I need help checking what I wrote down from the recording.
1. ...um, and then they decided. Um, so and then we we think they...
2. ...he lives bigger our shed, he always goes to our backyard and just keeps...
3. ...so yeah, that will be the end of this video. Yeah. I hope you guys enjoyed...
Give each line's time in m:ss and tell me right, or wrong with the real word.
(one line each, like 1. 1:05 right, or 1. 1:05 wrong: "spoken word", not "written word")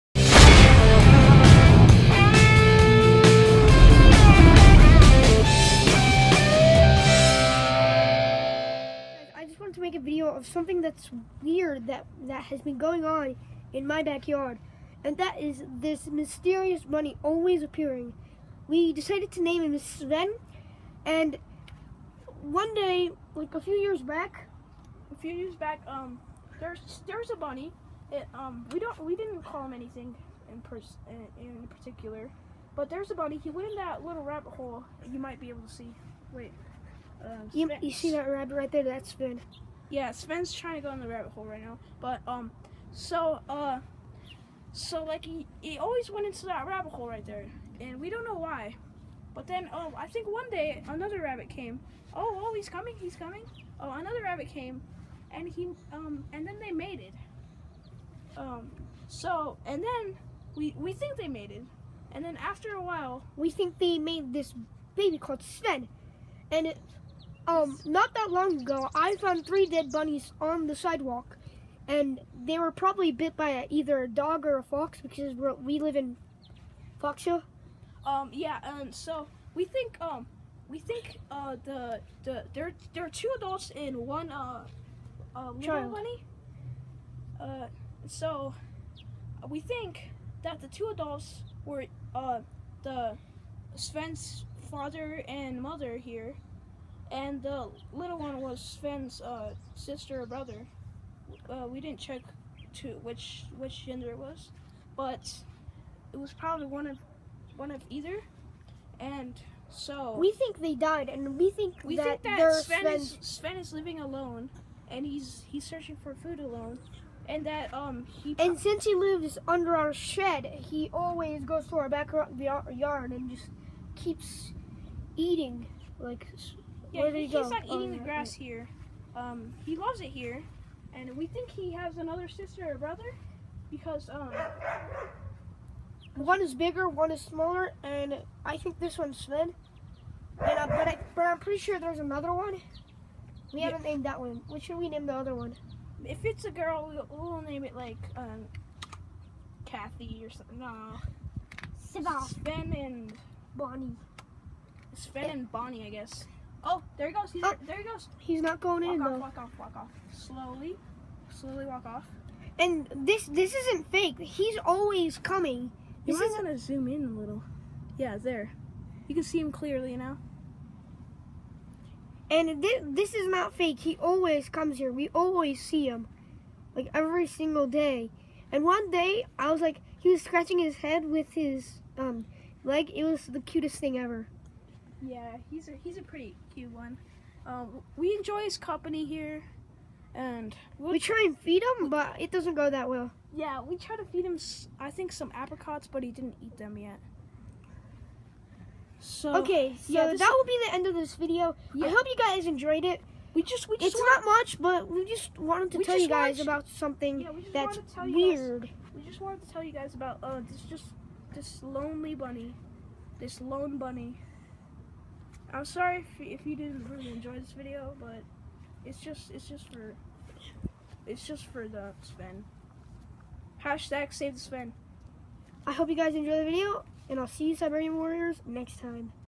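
1. 0:55 wrong: "mated", not "decided"
2. 1:58 wrong: "under", not "bigger"
3. 3:19 right.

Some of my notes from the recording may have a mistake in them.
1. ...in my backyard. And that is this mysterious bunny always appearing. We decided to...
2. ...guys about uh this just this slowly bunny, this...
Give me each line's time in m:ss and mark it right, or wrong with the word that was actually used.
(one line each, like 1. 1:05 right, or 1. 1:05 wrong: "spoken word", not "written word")
1. 0:13 right
2. 3:29 wrong: "lonely", not "slowly".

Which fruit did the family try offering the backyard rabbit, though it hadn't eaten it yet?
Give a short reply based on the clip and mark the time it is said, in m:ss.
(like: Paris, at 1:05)
Apricots, at 3:15.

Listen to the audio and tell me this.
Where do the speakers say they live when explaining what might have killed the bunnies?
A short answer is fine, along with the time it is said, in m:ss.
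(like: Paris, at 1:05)
Foxville, at 1:17.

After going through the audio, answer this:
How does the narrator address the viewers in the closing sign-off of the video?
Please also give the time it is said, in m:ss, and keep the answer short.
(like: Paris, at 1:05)
Siberian Warriors, at 3:47.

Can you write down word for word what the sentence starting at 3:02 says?
It was the cutest thing ever.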